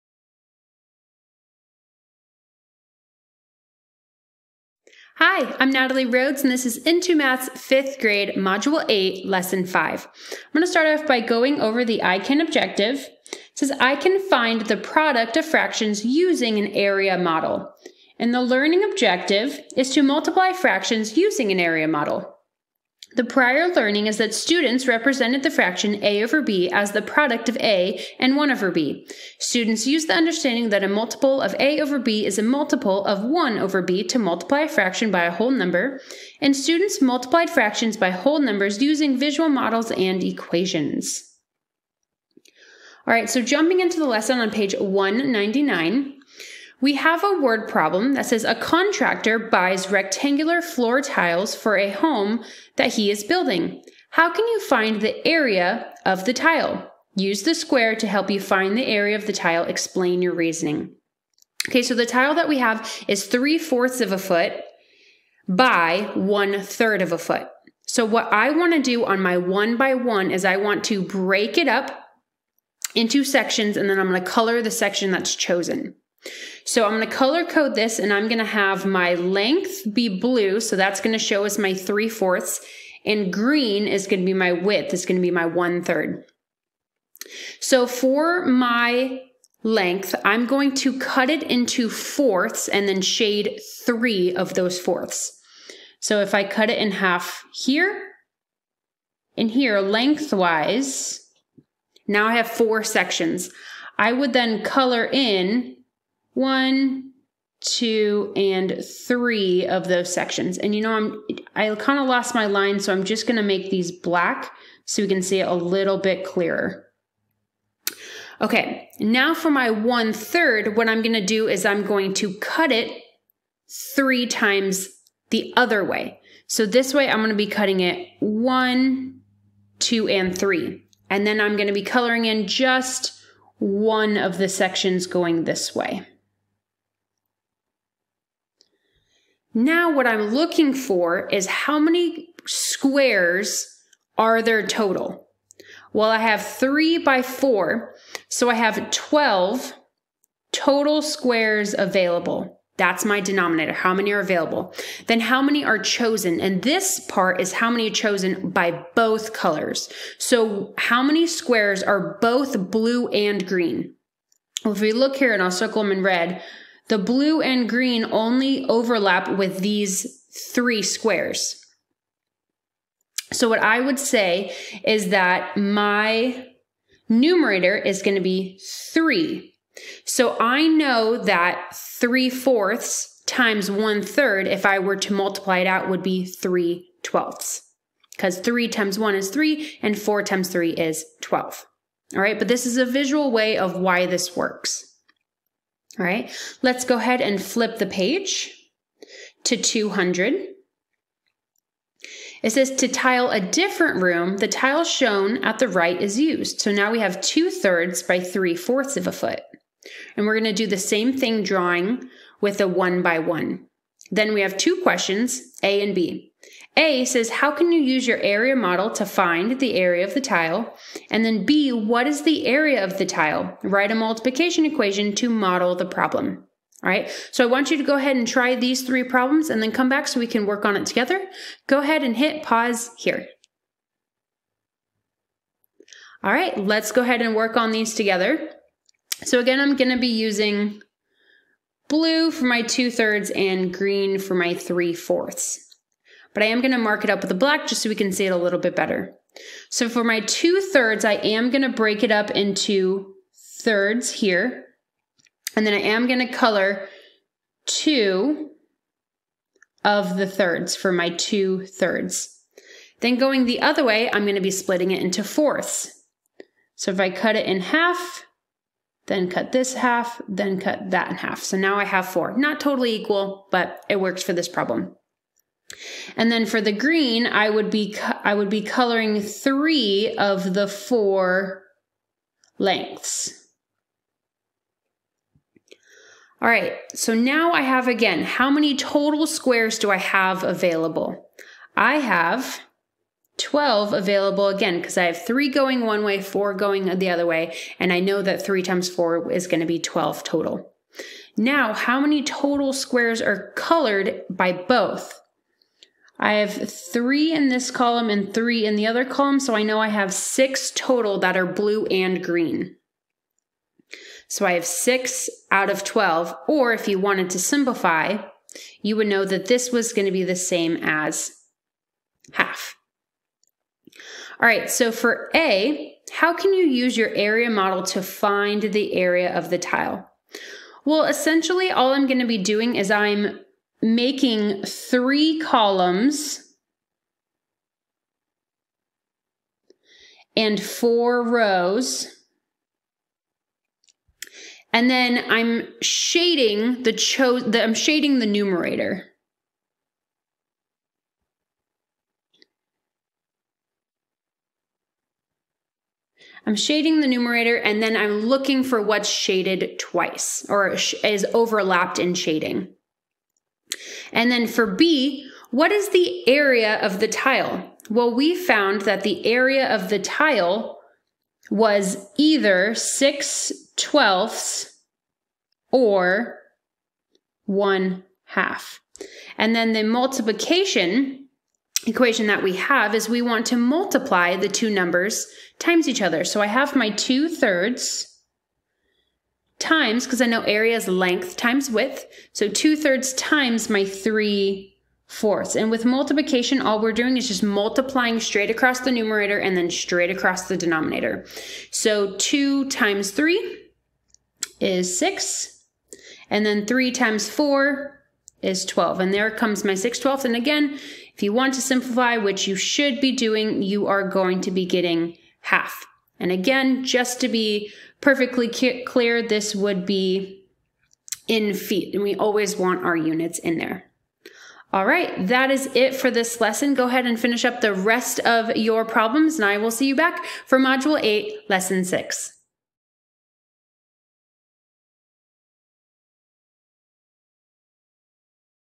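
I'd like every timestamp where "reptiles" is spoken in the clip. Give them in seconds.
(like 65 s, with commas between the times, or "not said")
not said.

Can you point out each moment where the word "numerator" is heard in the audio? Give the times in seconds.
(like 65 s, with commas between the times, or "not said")
177 s, 348 s, 357 s, 398 s.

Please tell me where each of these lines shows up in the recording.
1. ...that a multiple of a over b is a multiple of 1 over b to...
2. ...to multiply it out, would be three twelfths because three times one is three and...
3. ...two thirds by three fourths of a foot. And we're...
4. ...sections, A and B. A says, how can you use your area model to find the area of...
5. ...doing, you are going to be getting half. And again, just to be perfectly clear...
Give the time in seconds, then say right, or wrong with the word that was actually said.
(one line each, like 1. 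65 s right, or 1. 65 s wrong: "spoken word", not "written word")
1. 30 s right
2. 184 s right
3. 207 s right
4. 214 s wrong: "questions", not "sections"
5. 413 s right.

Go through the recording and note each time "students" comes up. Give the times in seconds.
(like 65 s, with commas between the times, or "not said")
24 s, 29 s, 36 s.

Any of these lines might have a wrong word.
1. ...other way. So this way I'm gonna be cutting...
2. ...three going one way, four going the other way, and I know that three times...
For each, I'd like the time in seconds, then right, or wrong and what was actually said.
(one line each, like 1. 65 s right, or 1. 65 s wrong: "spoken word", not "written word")
1. 125 s right
2. 295 s right.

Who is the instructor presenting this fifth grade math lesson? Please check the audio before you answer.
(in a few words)
Natalie Rhodes.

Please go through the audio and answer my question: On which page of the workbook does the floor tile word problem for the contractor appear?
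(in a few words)
199.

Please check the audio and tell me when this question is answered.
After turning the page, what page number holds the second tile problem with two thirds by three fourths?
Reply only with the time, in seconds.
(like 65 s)
199 s.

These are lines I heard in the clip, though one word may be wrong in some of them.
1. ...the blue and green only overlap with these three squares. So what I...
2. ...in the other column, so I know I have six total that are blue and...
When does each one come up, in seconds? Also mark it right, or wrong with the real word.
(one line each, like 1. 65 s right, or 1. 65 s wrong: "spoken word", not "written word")
1. 166 s right
2. 308 s right.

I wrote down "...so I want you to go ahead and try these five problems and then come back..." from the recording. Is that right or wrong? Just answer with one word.
wrong.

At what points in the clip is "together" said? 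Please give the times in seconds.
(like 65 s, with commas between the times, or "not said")
230 s, 237 s.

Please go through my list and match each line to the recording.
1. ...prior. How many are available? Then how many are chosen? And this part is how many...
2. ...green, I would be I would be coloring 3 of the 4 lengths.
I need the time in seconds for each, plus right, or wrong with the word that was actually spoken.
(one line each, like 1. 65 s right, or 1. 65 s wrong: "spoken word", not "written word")
1. 153 s wrong: "denominator", not "prior"
2. 276 s right.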